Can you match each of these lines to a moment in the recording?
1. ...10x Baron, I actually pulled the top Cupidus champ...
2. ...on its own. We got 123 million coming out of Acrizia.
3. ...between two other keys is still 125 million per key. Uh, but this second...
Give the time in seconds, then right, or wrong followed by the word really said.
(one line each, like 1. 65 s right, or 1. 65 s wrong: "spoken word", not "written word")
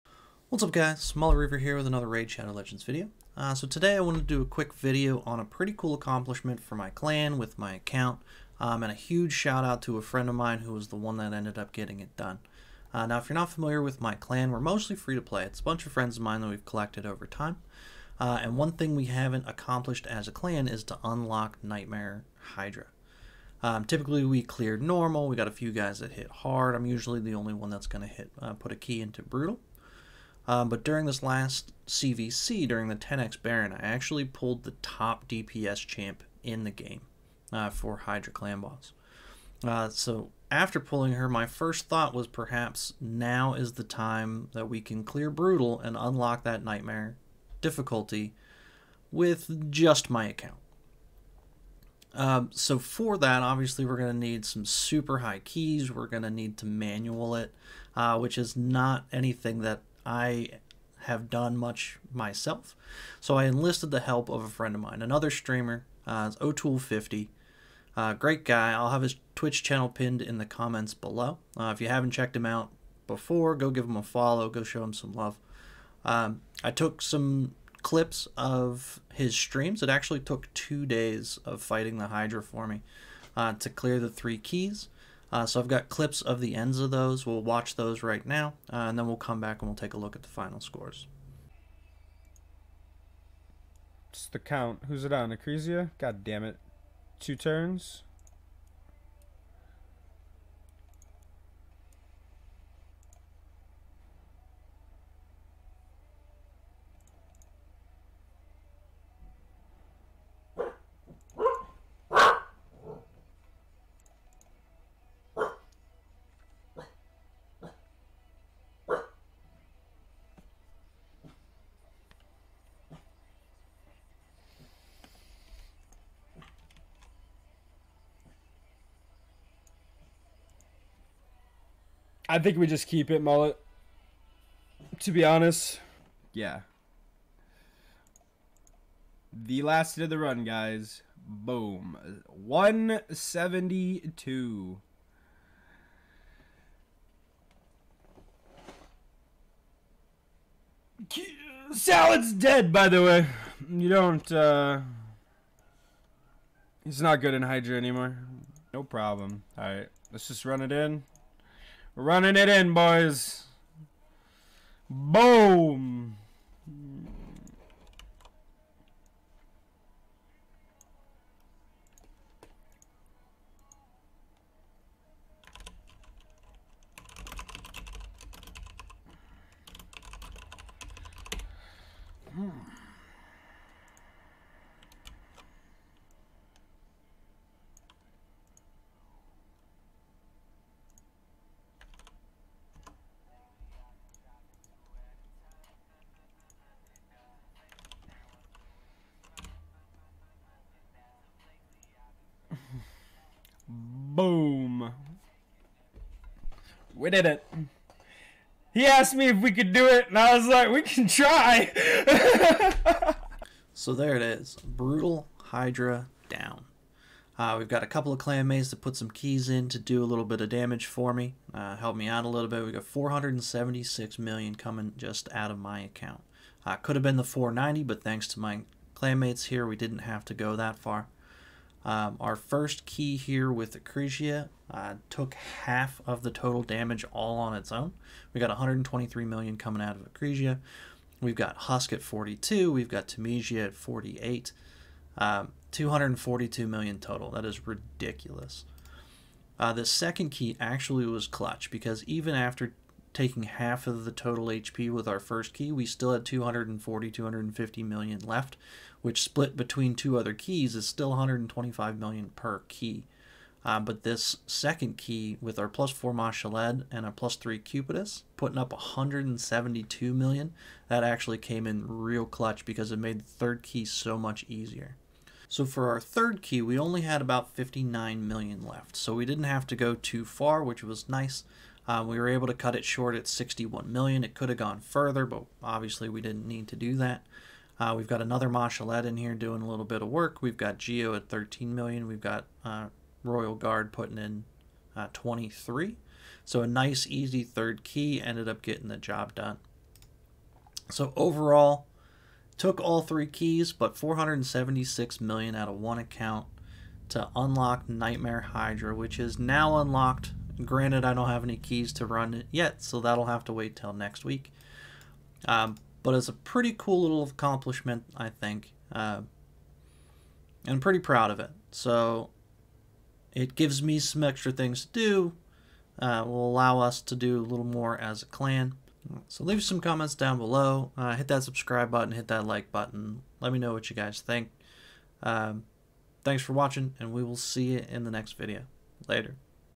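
1. 32 s wrong: "DPS", not "Cupidus"
2. 237 s right
3. 259 s right.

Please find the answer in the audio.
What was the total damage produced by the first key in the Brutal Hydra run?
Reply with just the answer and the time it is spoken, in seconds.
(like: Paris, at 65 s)
242 million, at 245 s.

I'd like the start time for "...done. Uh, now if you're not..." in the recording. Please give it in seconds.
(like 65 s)
12 s.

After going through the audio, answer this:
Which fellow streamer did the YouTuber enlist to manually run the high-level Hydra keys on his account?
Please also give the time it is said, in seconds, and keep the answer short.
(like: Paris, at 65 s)
O'Toole50, at 66 s.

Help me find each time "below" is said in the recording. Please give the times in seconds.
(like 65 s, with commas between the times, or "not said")
70 s, 330 s.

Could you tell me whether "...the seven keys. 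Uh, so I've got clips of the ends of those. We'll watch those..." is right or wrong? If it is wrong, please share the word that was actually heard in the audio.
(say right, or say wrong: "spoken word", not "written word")
wrong: "three", not "seven".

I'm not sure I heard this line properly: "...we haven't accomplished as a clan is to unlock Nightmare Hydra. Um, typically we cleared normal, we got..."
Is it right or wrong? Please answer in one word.
right.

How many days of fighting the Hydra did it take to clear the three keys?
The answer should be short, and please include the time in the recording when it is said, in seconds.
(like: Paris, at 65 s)
2, at 80 s.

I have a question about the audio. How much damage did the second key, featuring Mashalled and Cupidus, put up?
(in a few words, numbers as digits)
172 million.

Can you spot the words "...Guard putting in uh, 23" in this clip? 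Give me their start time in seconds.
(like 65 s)
293 s.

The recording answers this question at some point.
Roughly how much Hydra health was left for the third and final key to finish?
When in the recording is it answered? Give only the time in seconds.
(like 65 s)
277 s.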